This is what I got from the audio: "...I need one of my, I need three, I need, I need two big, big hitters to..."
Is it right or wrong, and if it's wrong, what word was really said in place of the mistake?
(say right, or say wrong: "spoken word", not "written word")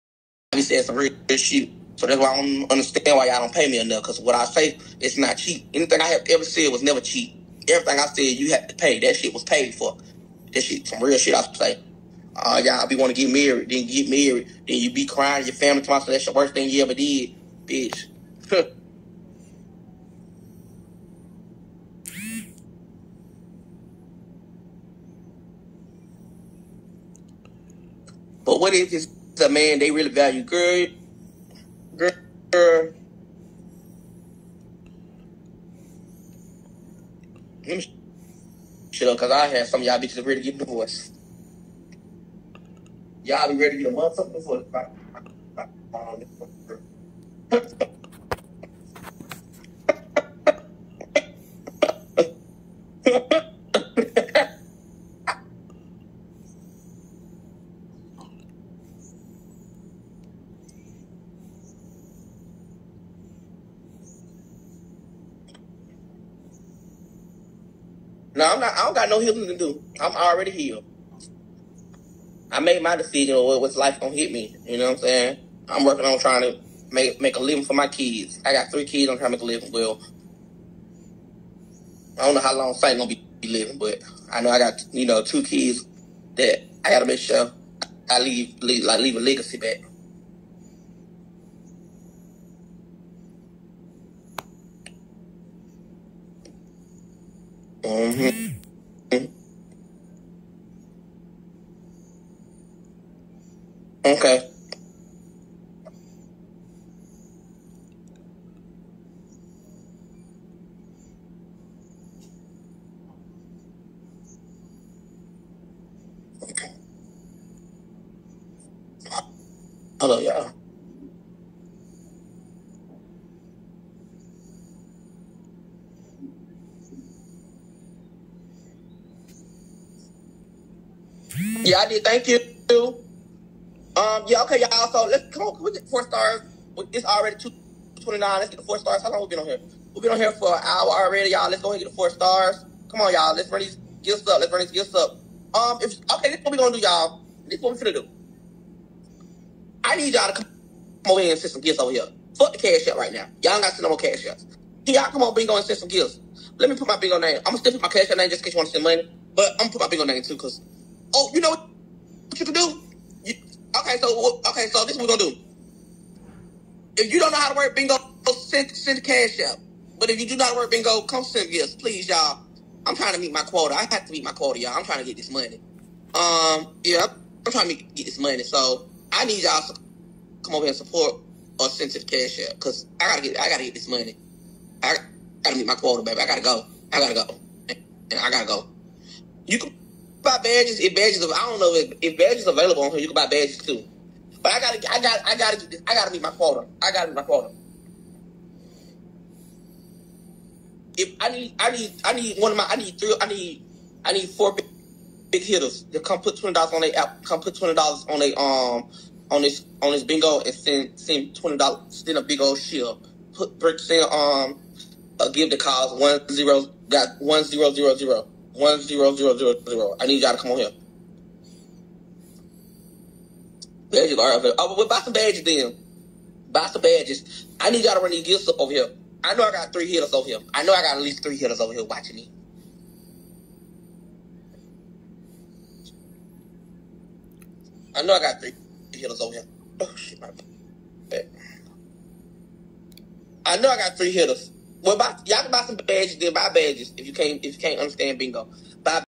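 wrong: "four", not "two".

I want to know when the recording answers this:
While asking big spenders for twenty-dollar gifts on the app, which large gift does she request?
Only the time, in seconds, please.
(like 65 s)
212 s.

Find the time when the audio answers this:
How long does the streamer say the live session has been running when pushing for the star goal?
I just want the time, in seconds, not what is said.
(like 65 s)
140 s.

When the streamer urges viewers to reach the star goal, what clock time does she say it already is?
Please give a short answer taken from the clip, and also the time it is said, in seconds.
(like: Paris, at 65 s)
2:29, at 137 s.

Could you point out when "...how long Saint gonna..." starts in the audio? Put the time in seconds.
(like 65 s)
82 s.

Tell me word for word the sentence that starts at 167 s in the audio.
If you don't know how to work bingo, send send cash out.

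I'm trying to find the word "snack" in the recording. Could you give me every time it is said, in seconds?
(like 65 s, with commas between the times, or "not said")
not said.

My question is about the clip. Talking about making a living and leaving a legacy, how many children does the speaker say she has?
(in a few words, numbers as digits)
3 kids.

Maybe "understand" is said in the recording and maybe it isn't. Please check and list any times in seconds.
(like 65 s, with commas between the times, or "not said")
2 s, 247 s.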